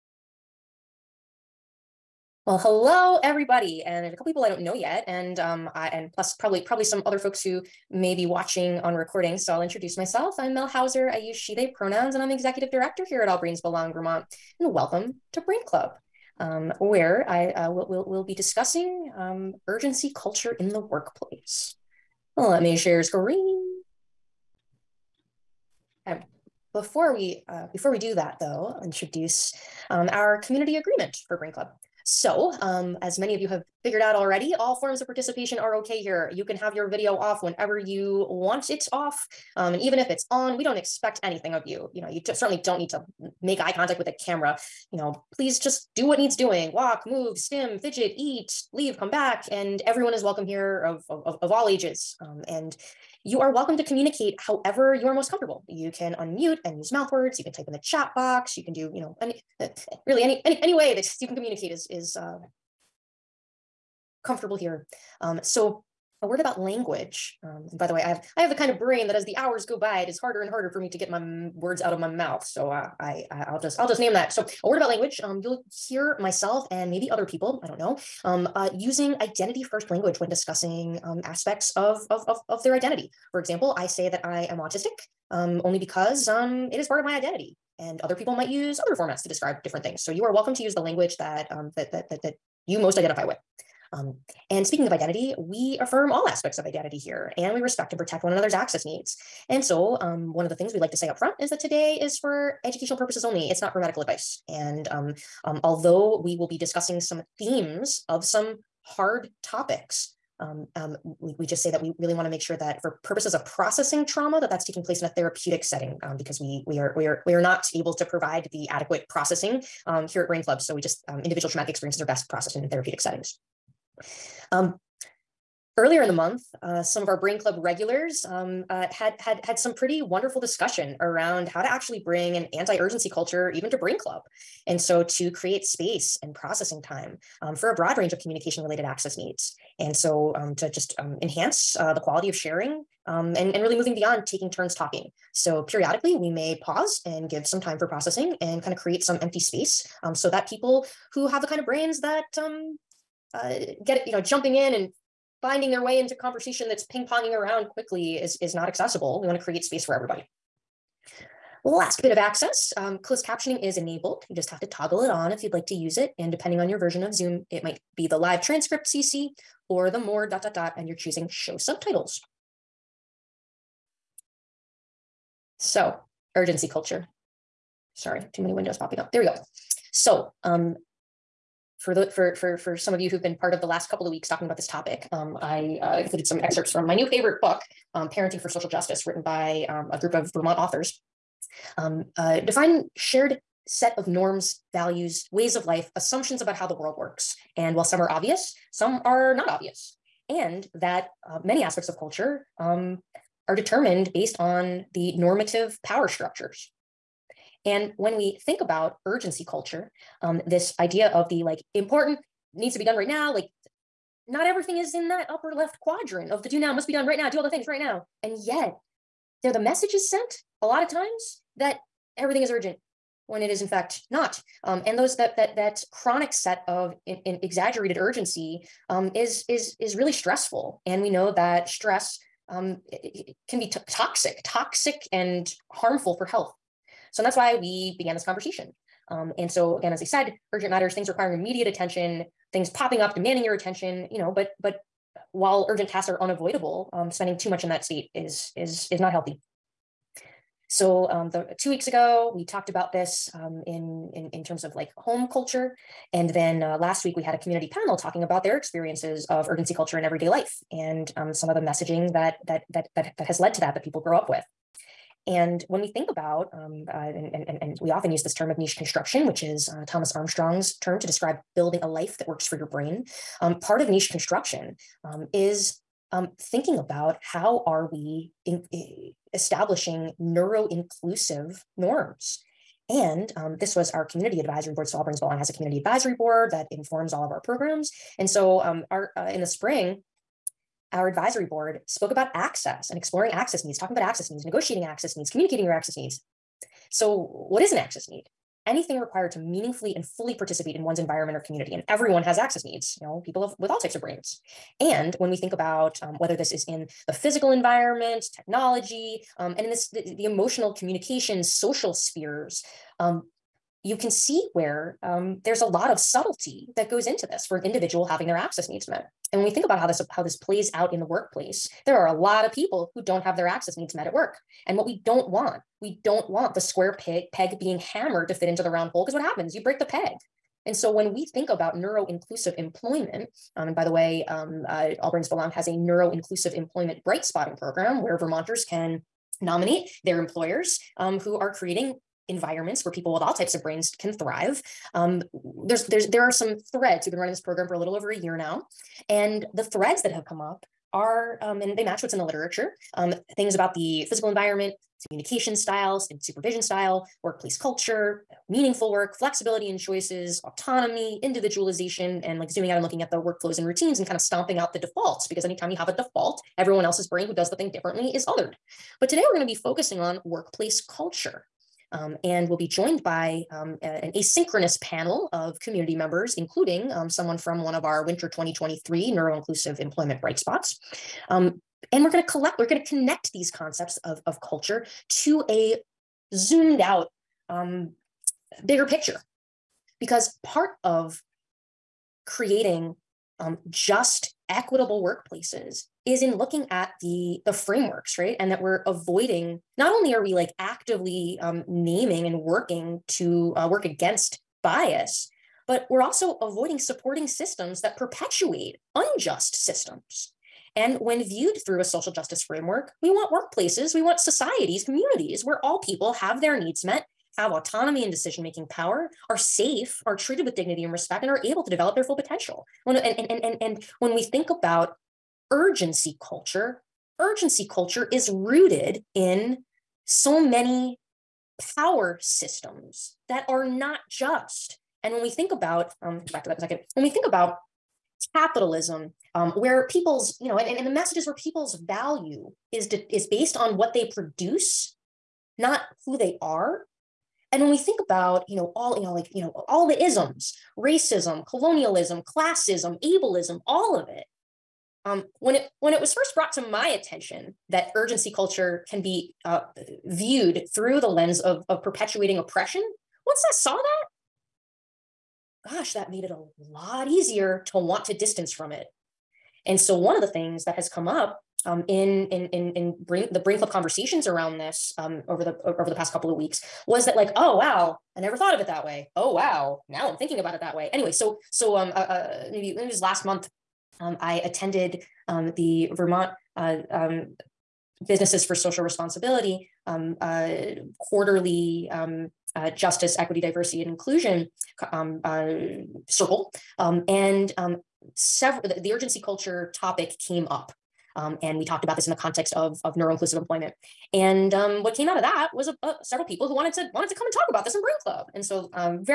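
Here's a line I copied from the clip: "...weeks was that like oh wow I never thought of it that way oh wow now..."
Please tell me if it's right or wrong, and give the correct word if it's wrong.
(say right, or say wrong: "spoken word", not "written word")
right.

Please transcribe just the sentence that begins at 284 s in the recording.
So All Brains Belong has a community advisory board that informs all of our programs.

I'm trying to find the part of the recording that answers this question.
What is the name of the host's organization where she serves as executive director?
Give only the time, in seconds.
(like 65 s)
13 s.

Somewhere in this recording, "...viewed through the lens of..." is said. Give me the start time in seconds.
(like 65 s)
460 s.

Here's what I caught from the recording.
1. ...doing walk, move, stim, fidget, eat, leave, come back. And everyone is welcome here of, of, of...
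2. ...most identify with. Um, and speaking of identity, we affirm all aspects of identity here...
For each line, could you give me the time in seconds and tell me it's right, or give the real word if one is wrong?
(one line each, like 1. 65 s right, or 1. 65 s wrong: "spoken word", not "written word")
1. 46 s right
2. 92 s right.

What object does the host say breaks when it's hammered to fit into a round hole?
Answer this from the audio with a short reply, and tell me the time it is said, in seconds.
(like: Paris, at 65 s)
the peg, at 329 s.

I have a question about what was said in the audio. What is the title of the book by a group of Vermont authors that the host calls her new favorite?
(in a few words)
Parenting for Social Justice.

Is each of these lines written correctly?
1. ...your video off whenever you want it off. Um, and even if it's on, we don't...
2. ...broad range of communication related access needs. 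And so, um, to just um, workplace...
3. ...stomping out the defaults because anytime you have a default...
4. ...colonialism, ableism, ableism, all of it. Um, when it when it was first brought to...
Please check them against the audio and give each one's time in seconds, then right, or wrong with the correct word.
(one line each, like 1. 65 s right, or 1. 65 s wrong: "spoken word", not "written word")
1. 36 s right
2. 137 s wrong: "enhance", not "workplace"
3. 364 s right
4. 451 s wrong: "classism", not "ableism".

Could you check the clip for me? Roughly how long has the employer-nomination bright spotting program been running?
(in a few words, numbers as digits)
a little over a year.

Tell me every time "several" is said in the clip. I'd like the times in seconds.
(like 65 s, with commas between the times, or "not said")
498 s, 506 s.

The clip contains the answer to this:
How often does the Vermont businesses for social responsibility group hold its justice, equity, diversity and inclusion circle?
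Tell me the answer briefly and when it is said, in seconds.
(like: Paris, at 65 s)
quarterly, at 491 s.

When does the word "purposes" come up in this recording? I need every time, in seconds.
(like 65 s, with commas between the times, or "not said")
102 s, 113 s.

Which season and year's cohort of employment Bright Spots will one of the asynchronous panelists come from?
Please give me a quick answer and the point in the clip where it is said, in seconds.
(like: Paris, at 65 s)
Winter 2023, at 378 s.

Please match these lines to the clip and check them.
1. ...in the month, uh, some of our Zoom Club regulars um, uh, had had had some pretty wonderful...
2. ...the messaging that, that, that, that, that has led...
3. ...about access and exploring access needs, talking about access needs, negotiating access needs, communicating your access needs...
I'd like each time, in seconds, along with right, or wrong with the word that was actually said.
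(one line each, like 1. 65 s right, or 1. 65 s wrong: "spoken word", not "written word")
1. 126 s wrong: "Brain", not "Zoom"
2. 261 s right
3. 292 s right.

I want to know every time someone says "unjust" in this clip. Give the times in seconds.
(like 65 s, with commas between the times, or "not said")
408 s.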